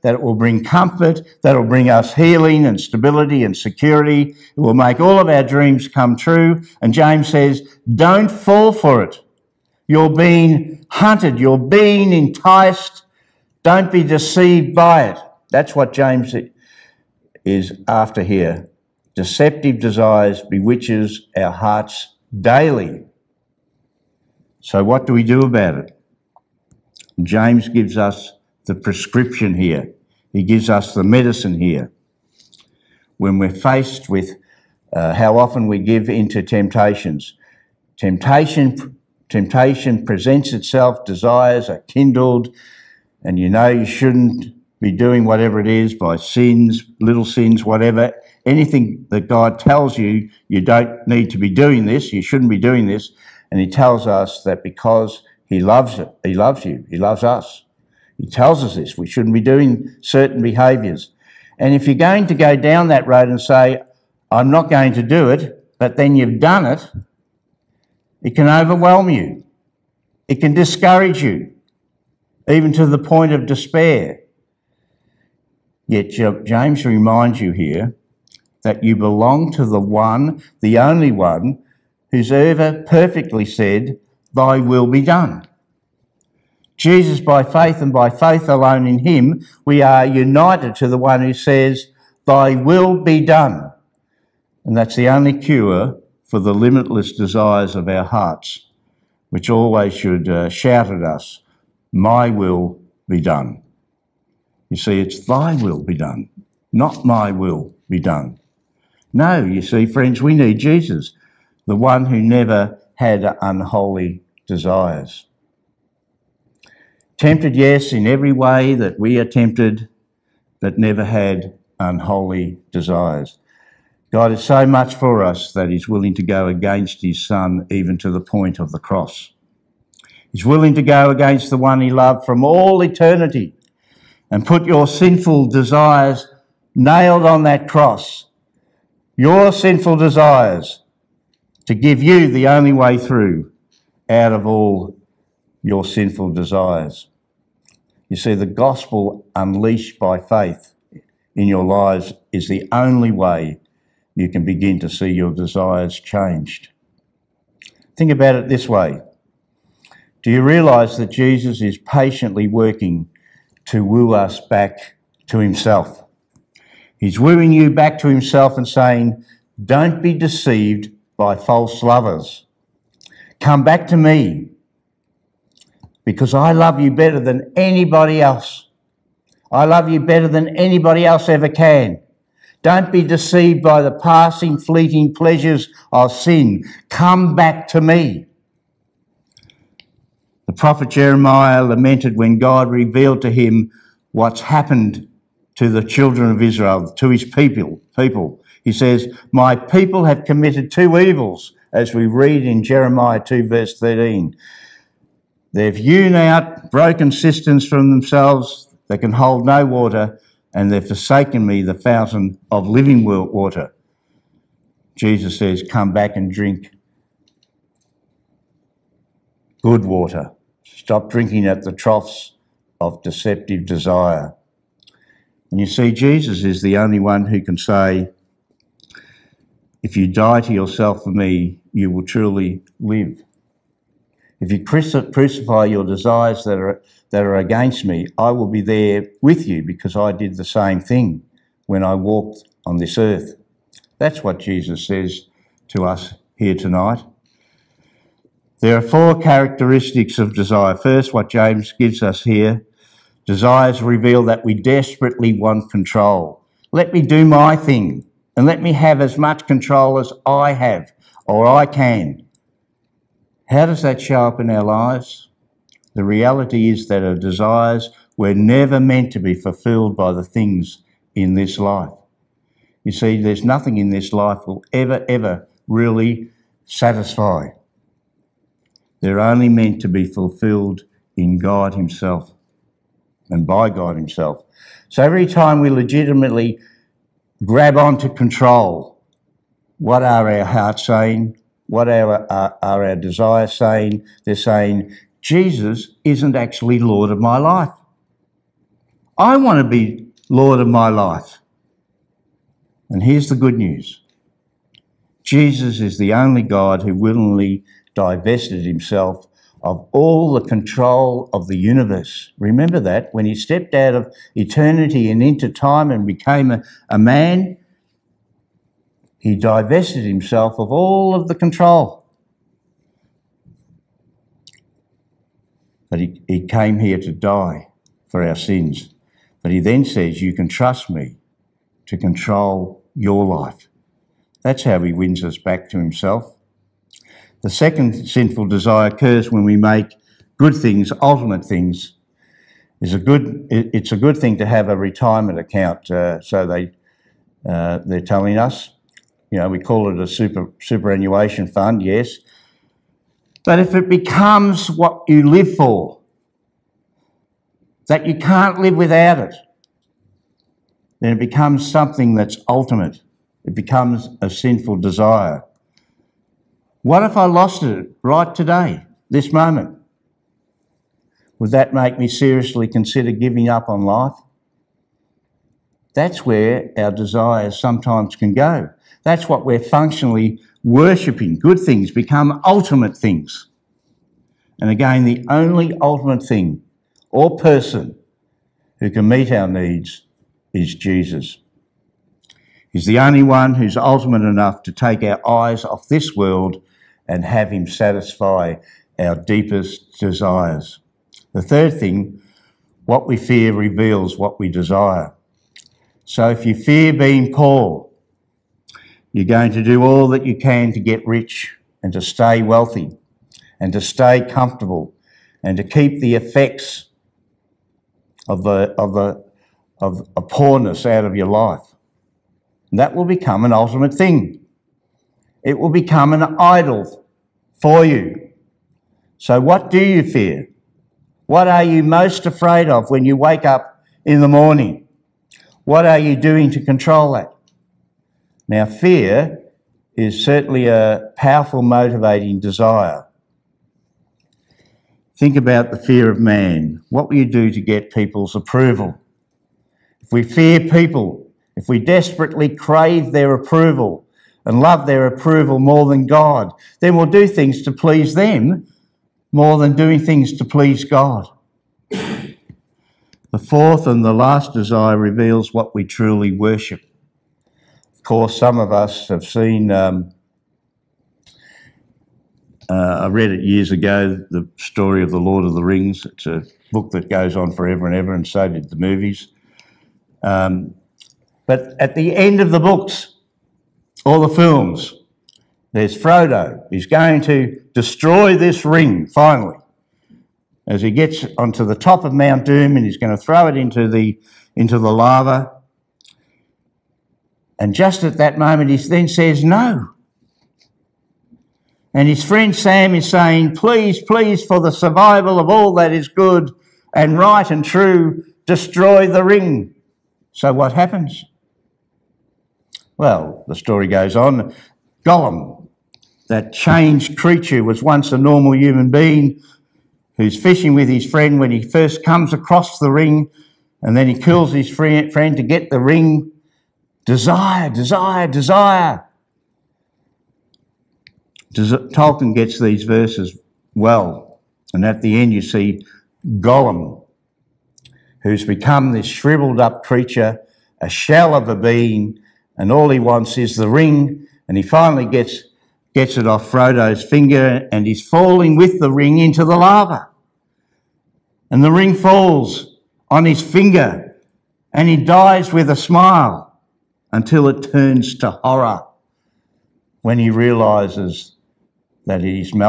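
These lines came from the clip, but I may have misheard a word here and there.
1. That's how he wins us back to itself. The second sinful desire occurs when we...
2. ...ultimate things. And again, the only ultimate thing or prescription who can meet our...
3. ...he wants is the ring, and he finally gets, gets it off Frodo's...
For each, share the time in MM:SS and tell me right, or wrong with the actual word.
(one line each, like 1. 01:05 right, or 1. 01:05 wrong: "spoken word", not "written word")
1. 05:34 wrong: "himself", not "itself"
2. 06:22 wrong: "person", not "prescription"
3. 09:02 right.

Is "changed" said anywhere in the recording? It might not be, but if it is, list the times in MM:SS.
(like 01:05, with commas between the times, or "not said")
02:35, 08:36.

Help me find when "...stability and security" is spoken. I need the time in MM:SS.
00:02.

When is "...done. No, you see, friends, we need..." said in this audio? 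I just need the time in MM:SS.
01:47.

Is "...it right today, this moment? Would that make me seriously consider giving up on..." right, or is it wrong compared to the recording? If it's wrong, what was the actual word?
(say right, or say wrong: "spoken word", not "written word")
right.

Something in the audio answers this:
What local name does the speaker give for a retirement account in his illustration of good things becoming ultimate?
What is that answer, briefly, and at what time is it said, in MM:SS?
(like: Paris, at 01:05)
Superannuation fund, at 05:50.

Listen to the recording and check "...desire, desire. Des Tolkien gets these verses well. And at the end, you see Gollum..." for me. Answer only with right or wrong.
right.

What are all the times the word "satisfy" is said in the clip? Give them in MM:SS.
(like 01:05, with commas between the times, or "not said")
04:36, 06:37.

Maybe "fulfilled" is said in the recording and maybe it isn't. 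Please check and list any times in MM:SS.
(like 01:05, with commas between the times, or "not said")
04:29, 04:40.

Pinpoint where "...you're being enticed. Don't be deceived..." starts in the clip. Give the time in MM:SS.
00:11.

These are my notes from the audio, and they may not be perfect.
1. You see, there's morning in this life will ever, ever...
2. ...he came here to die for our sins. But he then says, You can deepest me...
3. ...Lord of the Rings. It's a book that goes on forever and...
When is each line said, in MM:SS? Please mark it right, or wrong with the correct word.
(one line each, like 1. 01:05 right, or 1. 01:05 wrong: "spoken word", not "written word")
1. 04:32 wrong: "nothing", not "morning"
2. 05:26 wrong: "trust", not "deepest"
3. 07:55 right.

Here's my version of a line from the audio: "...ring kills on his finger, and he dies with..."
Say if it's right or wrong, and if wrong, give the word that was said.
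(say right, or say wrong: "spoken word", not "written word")
wrong: "falls", not "kills".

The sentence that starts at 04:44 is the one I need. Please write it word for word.
So every time we legitimately grab onto control.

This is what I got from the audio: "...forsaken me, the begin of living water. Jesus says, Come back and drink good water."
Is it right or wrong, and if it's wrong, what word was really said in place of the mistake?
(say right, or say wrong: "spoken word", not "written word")
wrong: "fountain", not "begin".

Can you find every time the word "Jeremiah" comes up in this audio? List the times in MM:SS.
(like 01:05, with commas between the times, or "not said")
03:10, 03:22.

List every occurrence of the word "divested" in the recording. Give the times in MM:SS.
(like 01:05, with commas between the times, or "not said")
05:07, 05:19.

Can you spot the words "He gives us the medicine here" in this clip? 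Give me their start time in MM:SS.
00:30.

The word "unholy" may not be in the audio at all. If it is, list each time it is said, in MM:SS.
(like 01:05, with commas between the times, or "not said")
01:53, 02:01.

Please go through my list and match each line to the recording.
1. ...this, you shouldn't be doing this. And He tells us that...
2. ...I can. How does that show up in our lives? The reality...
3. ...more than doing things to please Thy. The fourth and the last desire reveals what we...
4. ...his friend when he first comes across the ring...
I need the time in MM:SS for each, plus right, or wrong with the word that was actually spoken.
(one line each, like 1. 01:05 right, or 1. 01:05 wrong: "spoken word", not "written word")
1. 00:51 right
2. 04:21 right
3. 07:39 wrong: "God", not "Thy"
4. 08:40 right.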